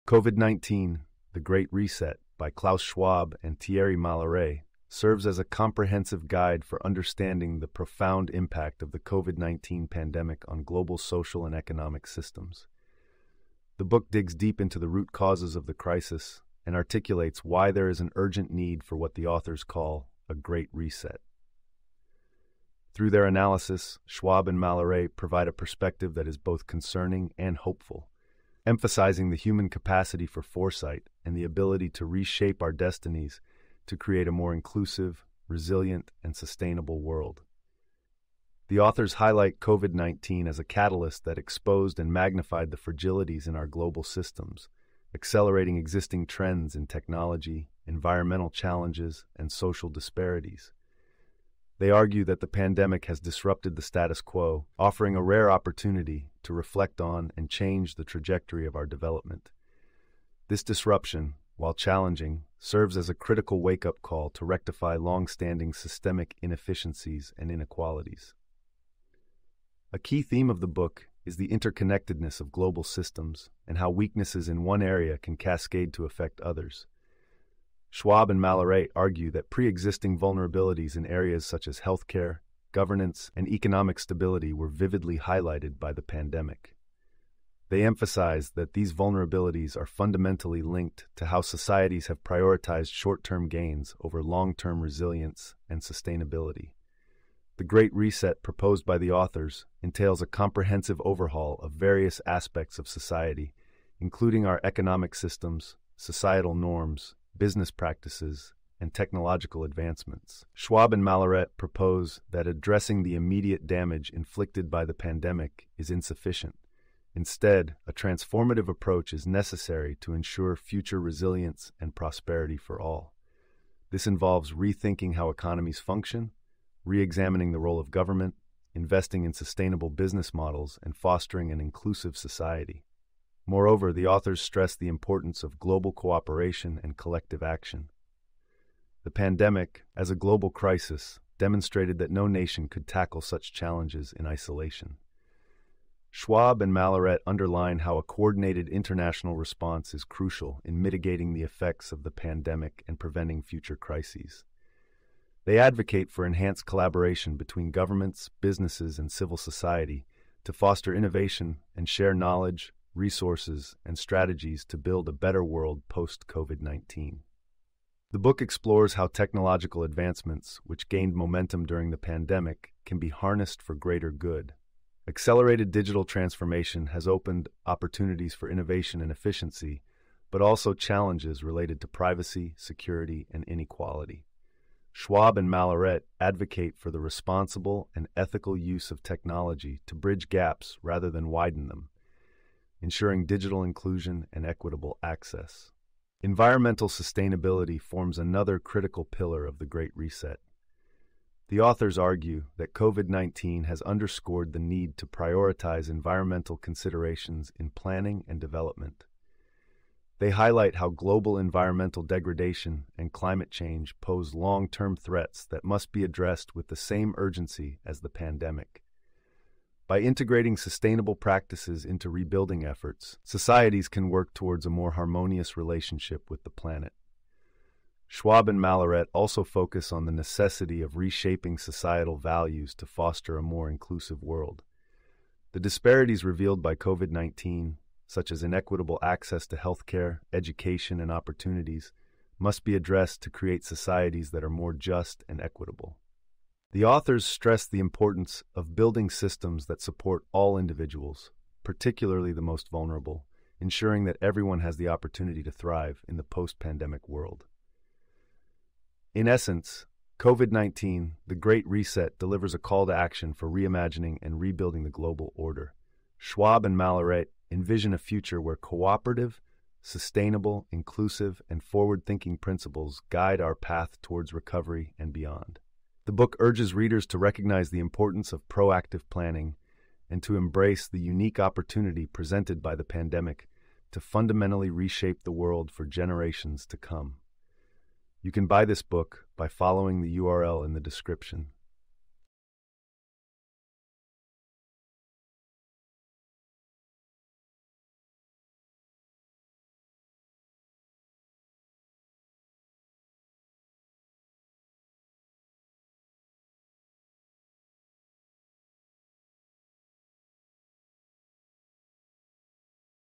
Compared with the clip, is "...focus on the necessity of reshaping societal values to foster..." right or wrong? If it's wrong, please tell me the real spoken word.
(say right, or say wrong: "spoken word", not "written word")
right.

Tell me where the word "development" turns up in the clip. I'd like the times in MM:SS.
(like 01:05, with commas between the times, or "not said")
00:58, 03:28.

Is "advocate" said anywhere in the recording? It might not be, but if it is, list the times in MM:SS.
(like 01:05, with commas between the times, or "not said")
02:35, 03:06.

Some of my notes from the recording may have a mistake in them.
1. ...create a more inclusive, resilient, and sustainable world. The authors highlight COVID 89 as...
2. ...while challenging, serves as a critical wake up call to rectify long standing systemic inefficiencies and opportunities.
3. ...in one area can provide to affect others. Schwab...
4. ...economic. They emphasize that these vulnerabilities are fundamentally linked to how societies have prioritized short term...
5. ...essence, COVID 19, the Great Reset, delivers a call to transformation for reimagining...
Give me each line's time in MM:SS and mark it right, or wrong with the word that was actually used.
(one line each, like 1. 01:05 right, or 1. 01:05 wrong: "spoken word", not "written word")
1. 00:33 wrong: "19", not "89"
2. 01:01 wrong: "inequalities", not "opportunities"
3. 01:14 wrong: "cascade", not "provide"
4. 01:26 wrong: "pandemic", not "economic"
5. 04:19 wrong: "action", not "transformation".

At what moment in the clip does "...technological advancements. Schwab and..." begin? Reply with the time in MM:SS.
01:48.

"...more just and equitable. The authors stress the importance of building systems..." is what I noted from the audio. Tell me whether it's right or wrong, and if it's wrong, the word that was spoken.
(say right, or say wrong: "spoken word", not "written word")
right.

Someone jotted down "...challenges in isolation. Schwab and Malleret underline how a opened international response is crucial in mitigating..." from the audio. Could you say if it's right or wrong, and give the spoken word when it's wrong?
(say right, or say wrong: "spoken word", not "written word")
wrong: "coordinated", not "opened".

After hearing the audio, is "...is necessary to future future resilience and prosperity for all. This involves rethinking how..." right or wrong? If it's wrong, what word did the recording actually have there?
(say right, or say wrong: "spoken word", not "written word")
wrong: "ensure", not "future".